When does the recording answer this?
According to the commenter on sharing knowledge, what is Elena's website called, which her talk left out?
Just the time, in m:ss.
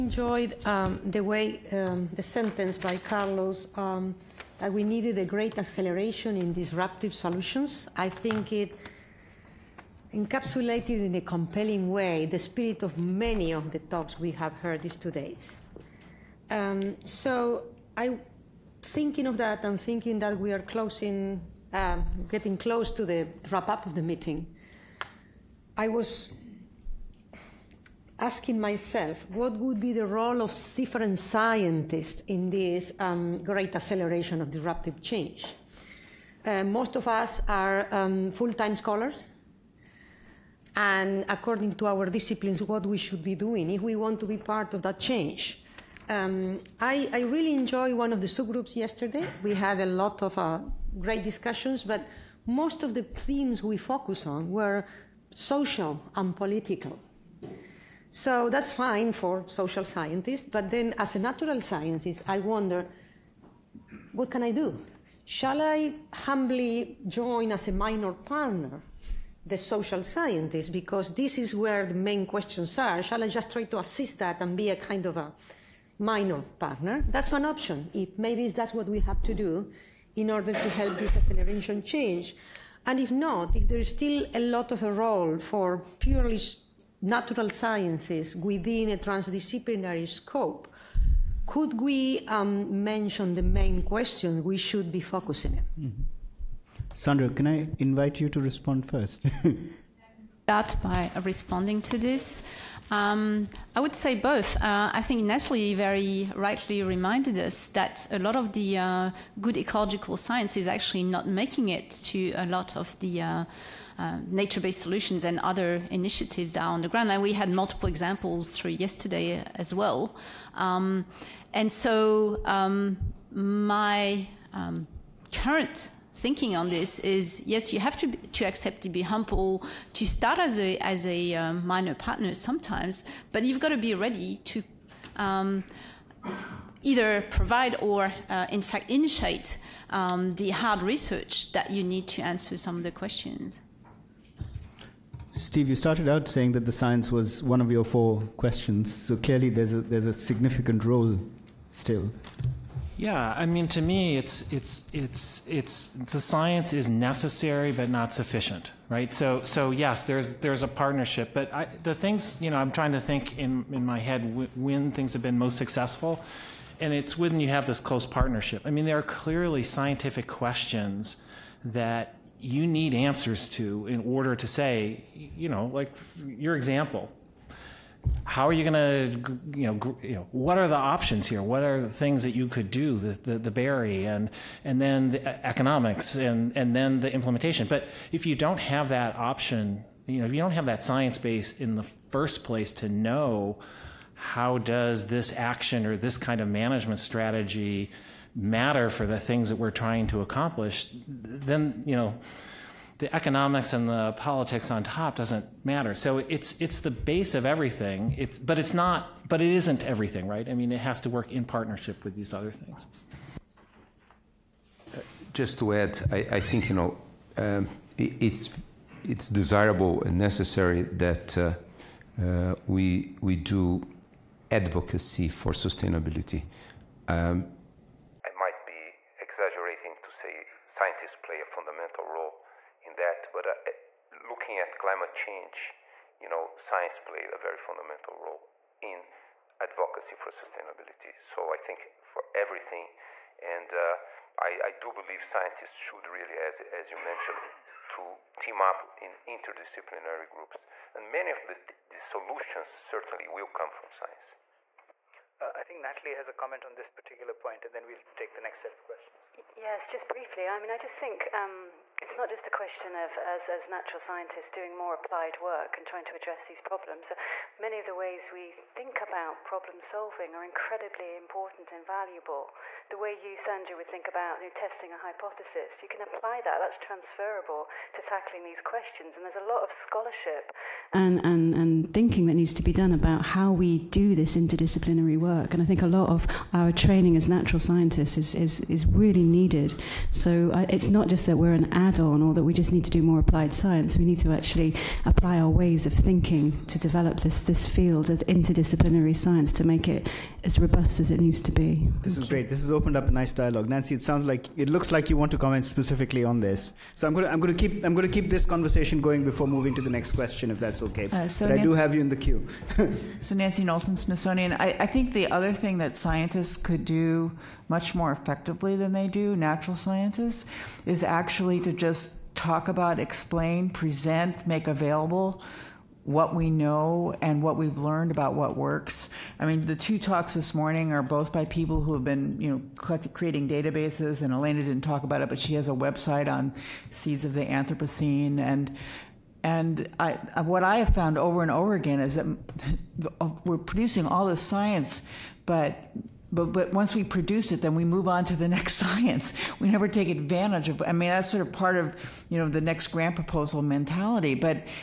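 5:36.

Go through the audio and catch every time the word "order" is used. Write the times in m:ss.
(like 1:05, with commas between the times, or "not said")
1:20, 2:54.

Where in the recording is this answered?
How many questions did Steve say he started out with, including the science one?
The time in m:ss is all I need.
2:27.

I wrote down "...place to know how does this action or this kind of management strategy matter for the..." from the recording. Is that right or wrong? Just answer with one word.
right.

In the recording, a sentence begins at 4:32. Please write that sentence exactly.
The way you, Sandra, would think about you know, testing a hypothesis, you can apply that.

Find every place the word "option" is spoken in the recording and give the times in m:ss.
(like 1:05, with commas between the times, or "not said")
1:17, 3:00, 3:09.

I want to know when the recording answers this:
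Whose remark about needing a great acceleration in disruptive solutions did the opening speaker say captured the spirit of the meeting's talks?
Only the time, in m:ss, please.
0:02.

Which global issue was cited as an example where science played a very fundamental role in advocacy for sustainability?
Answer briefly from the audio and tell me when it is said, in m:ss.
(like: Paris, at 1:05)
Climate change, at 3:54.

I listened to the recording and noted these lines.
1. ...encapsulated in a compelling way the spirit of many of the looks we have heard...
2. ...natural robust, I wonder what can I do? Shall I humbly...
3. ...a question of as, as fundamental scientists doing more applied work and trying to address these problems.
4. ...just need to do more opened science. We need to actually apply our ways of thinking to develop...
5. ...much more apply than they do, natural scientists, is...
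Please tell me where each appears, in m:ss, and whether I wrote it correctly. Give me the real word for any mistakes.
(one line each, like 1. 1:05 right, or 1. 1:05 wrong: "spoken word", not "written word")
1. 0:10 wrong: "talks", not "looks"
2. 1:01 wrong: "scientist", not "robust"
3. 4:22 wrong: "natural", not "fundamental"
4. 4:52 wrong: "applied", not "opened"
5. 5:17 wrong: "effectively", not "apply".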